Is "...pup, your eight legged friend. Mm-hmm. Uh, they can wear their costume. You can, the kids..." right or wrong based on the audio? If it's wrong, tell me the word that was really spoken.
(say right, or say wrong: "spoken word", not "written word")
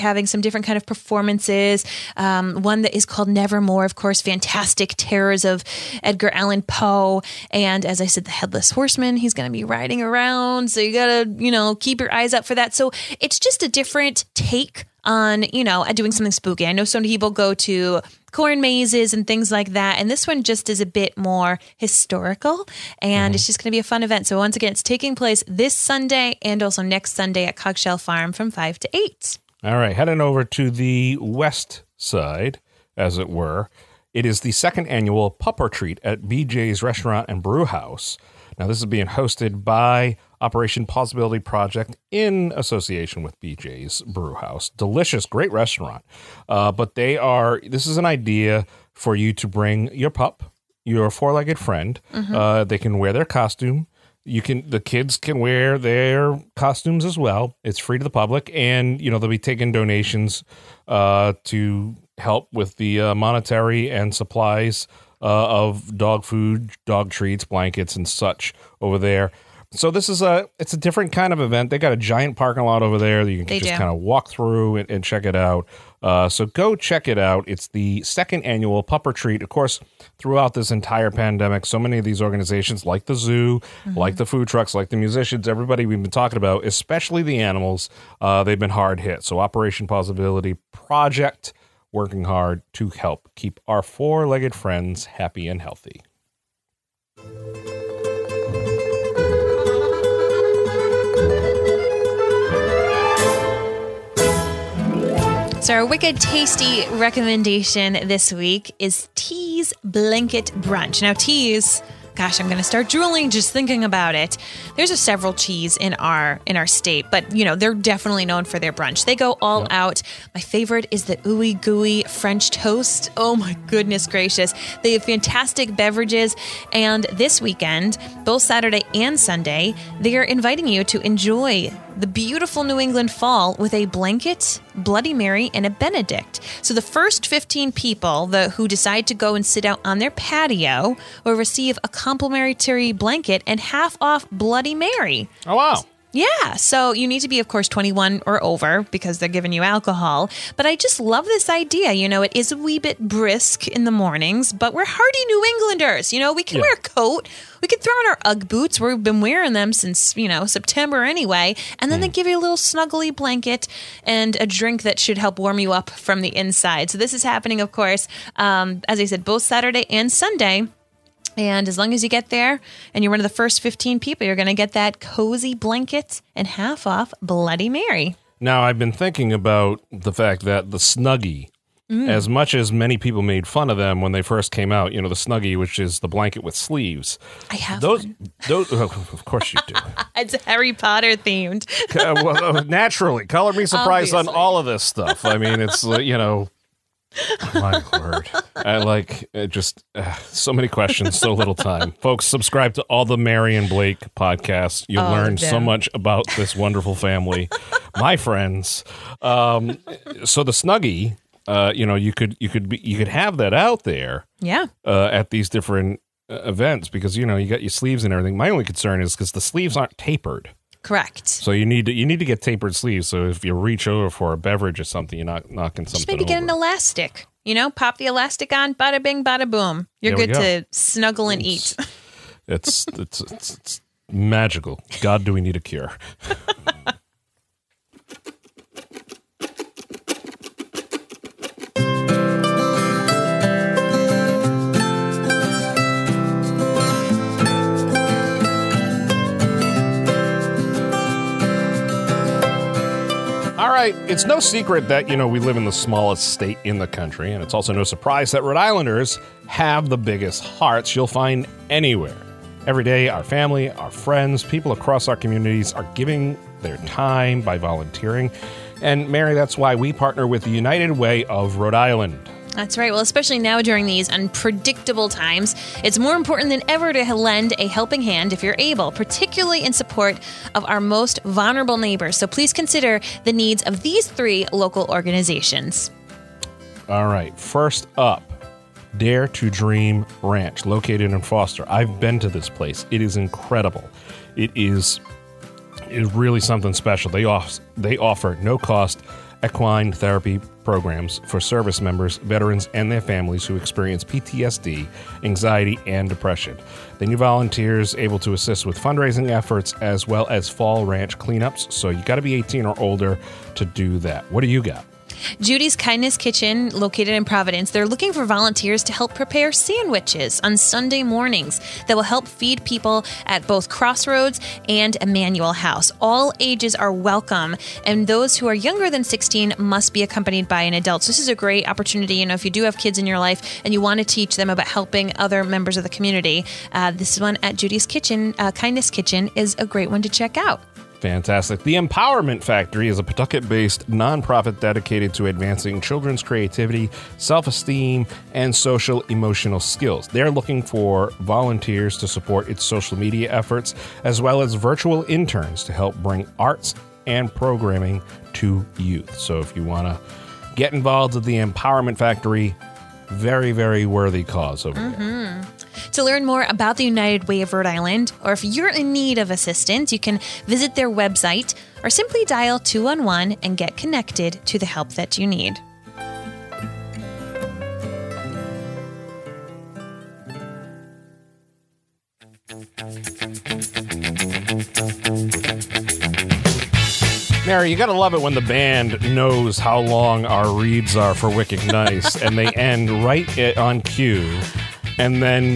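wrong: "four", not "eight".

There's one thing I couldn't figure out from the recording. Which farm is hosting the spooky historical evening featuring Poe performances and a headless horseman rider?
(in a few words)
Coggeshall Farm.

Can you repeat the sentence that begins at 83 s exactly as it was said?
like the food trucks, like the musicians, everybody we've been talking about, especially the animals, uh, they've been hard hit.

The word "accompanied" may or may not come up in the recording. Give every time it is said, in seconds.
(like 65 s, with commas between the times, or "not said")
330 s.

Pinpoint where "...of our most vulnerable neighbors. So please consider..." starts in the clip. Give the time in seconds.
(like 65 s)
280 s.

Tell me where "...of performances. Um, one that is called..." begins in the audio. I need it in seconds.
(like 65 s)
0 s.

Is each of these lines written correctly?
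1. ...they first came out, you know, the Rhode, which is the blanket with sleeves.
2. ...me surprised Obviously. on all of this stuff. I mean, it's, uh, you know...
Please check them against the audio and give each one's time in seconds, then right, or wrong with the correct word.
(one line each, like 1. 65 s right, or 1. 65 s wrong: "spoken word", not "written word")
1. 184 s wrong: "Snuggie", not "Rhode"
2. 193 s right.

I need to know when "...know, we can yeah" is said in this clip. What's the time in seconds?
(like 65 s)
156 s.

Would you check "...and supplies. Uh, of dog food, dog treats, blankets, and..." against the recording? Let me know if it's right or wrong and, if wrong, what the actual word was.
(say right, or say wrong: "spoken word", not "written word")
right.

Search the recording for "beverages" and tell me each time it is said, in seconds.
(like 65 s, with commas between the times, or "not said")
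125 s, 224 s.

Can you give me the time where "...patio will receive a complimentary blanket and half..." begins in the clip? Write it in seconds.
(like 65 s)
140 s.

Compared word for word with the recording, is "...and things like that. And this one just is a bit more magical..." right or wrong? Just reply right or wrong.
wrong.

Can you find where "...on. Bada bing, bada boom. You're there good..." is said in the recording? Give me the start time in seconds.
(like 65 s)
228 s.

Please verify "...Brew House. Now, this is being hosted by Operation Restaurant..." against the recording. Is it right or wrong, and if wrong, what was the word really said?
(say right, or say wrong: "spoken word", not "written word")
wrong: "Possibility", not "Restaurant".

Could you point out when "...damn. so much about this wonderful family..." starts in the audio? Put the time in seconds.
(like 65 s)
205 s.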